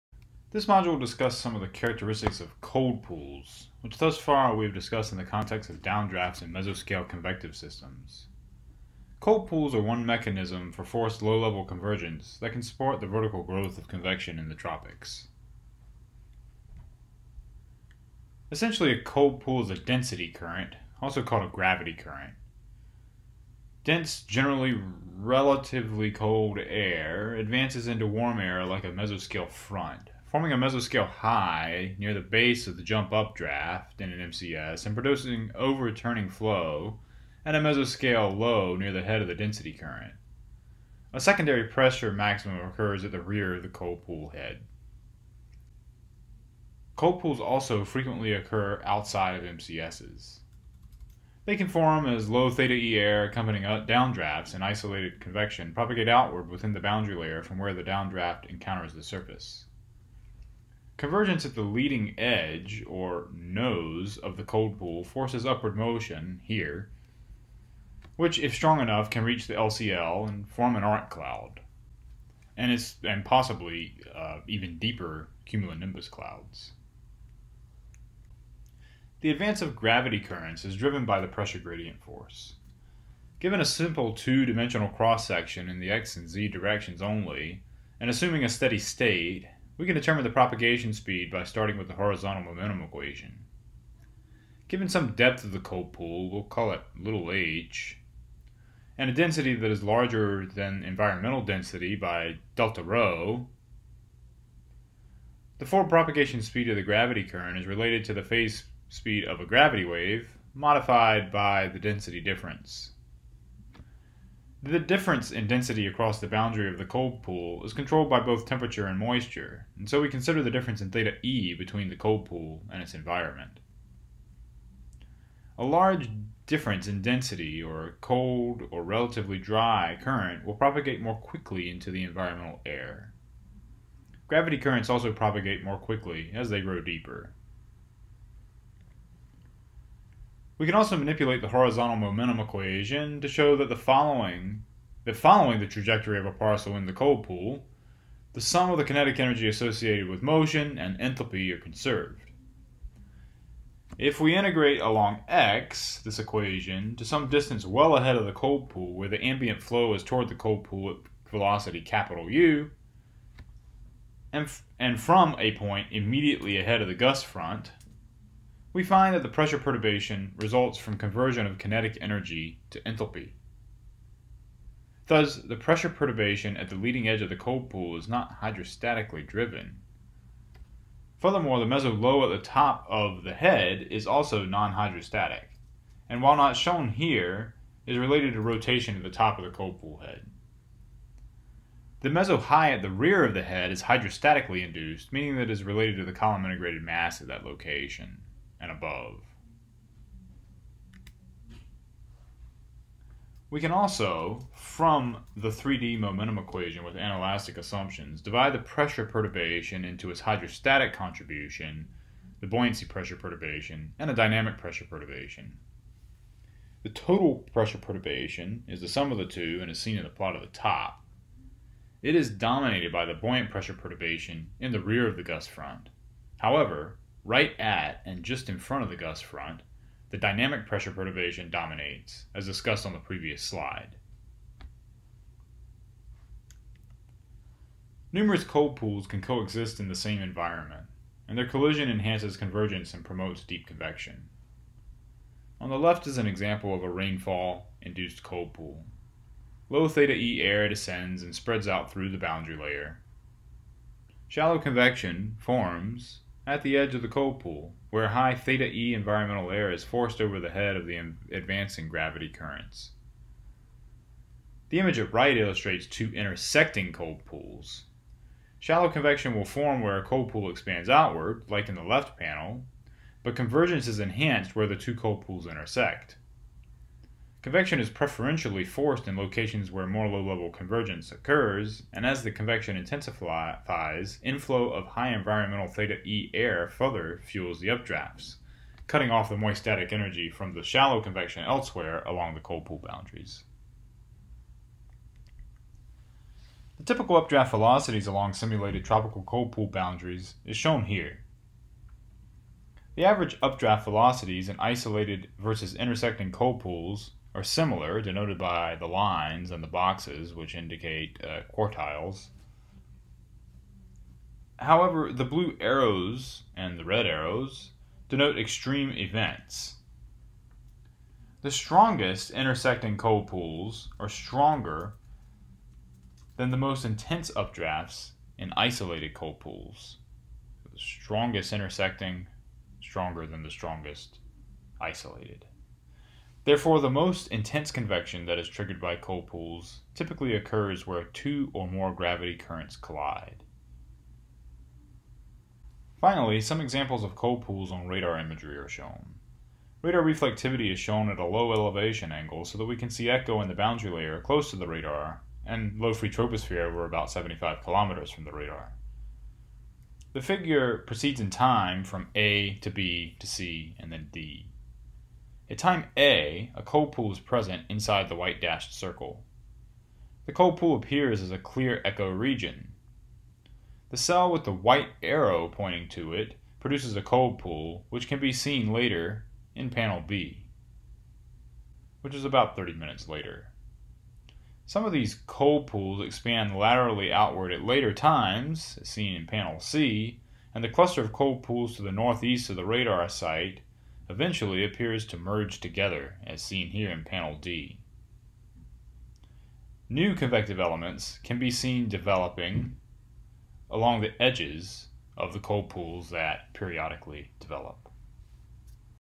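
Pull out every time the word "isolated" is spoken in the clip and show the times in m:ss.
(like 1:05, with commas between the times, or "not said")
0:54, 5:04, 5:28, 5:34.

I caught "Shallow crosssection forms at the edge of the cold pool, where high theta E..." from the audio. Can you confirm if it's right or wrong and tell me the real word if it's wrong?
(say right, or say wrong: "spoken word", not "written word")
wrong: "convection", not "crosssection".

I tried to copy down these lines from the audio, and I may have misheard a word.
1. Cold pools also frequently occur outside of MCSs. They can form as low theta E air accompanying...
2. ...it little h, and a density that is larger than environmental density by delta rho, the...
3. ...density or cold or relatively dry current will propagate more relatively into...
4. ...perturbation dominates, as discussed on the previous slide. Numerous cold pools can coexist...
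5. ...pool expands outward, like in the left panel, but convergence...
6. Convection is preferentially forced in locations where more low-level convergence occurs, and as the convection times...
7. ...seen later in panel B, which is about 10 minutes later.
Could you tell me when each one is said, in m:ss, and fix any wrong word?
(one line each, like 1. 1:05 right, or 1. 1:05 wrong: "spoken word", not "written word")
1. 0:46 right
2. 1:36 right
3. 2:07 wrong: "quickly", not "relatively"
4. 3:50 right
5. 4:30 right
6. 4:37 wrong: "intensifies", not "times"
7. 6:18 wrong: "30", not "10".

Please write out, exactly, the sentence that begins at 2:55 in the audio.
Thus, the pressure perturbation at the leading edge of the cold pool is not hydrostatically driven.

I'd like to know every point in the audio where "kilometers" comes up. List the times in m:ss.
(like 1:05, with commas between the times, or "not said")
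5:57.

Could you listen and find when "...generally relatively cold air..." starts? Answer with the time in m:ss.
0:24.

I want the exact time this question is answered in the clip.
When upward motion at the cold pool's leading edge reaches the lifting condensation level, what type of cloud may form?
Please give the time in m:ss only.
1:10.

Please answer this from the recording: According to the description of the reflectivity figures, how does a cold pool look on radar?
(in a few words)
clear echo region.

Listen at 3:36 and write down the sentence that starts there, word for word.
The total pressure perturbation is the sum of the two and is seen in the plot at the top.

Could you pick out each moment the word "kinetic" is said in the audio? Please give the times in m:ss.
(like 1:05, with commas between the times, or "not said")
2:28, 2:51.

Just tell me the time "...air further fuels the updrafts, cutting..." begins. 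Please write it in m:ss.
4:46.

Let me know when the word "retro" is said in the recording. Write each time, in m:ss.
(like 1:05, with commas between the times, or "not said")
not said.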